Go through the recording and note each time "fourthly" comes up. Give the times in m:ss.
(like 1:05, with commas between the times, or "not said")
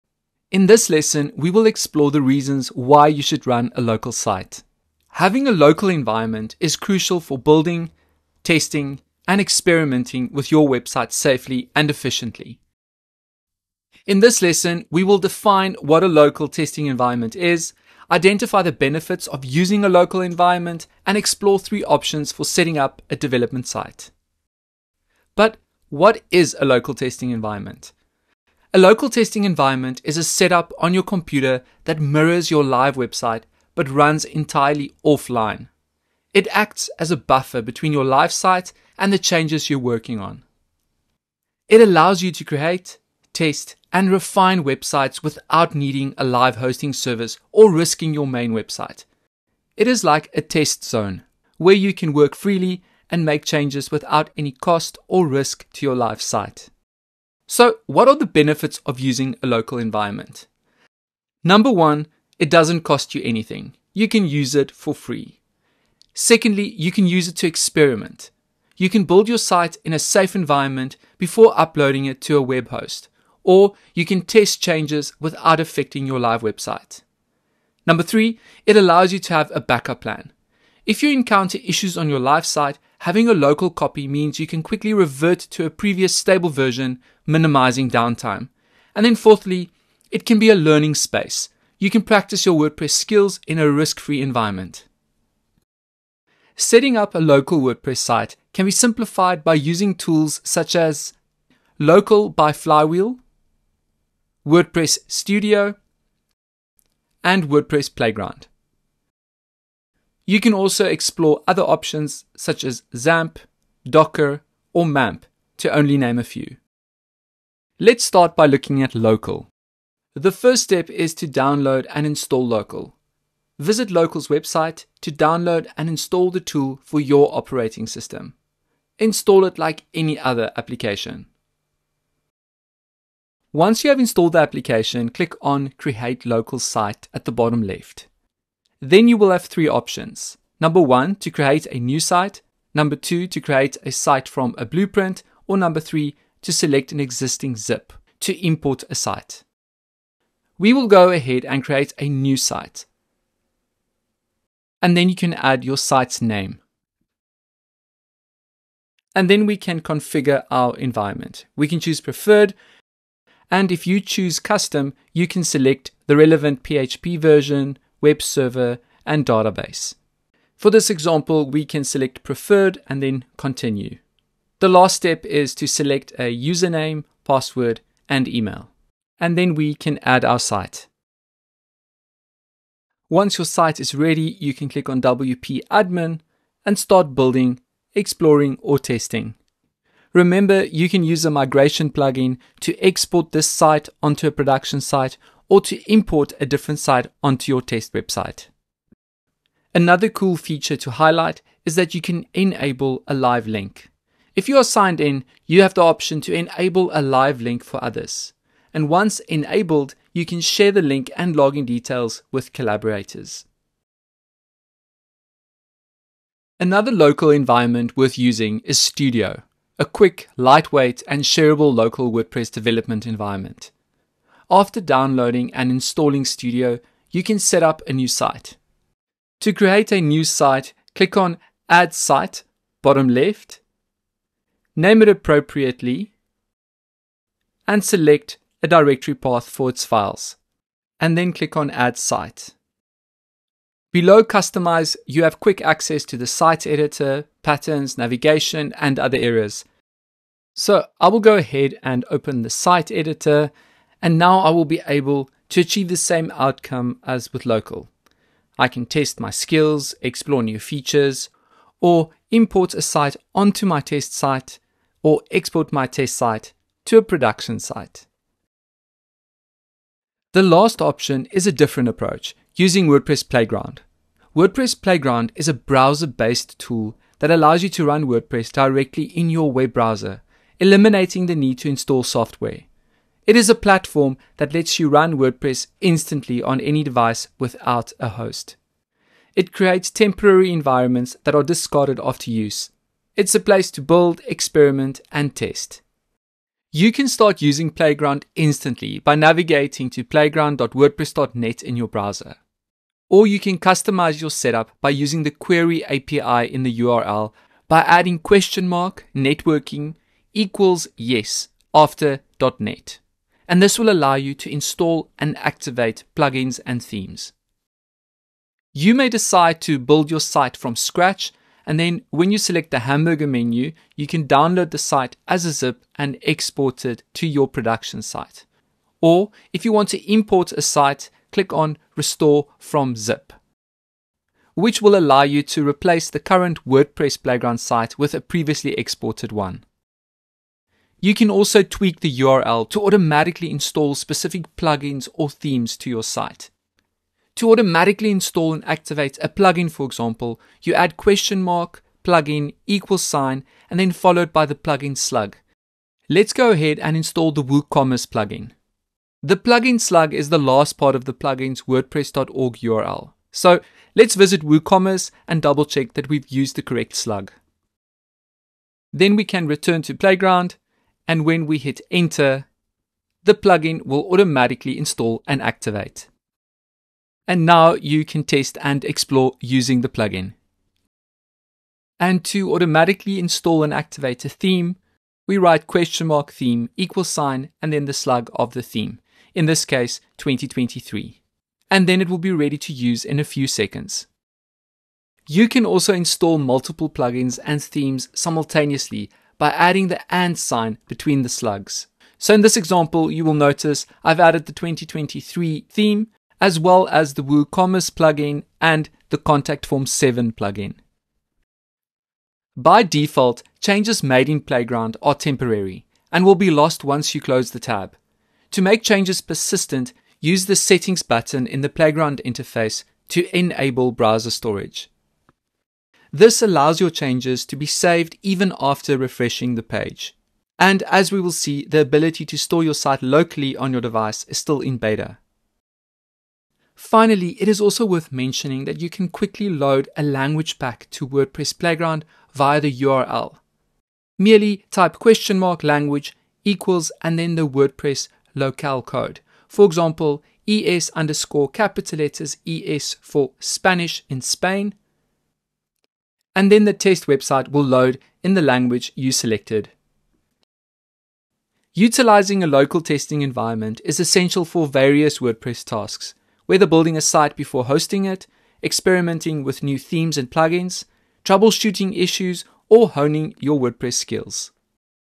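1:29.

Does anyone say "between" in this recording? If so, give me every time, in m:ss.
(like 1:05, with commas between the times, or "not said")
0:37, 6:40.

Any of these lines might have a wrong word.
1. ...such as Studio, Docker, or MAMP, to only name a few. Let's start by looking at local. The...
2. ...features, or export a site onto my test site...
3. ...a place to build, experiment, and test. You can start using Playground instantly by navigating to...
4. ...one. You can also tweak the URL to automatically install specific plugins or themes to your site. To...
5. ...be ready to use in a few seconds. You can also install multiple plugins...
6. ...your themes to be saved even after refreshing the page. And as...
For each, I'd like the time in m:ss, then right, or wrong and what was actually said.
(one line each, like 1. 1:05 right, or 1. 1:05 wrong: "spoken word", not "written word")
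1. 1:52 wrong: "XAMPP", not "Studio"
2. 4:20 wrong: "import", not "export"
3. 4:53 right
4. 5:39 right
5. 6:32 right
6. 7:06 wrong: "changes", not "themes".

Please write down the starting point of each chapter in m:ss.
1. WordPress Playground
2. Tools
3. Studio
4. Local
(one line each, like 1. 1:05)
1. 4:28
2. 1:35
3. 3:35
4. 1:56.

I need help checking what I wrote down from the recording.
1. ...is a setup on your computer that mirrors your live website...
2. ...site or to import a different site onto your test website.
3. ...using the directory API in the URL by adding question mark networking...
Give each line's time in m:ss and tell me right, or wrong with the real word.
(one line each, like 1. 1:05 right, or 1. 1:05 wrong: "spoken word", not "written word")
1. 0:30 right
2. 3:14 right
3. 5:04 wrong: "query", not "directory".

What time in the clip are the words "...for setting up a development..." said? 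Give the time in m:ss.
0:22.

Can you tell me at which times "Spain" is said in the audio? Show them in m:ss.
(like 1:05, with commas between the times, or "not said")
7:34.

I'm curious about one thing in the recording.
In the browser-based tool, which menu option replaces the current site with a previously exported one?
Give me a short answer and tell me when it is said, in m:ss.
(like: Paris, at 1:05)
Restore from Zip, at 5:31.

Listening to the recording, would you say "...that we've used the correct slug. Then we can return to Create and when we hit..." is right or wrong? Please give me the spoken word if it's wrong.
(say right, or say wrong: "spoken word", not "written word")
wrong: "Playground", not "Create".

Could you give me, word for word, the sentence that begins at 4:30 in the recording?
The last option is a different approach using WordPress Playground.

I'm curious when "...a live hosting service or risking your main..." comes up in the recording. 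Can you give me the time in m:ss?
0:46.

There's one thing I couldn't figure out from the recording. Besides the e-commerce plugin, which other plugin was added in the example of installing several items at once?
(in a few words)
Contact Form 7.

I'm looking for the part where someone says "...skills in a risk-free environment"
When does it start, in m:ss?
1:32.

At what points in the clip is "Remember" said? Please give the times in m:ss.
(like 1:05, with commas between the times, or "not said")
3:10.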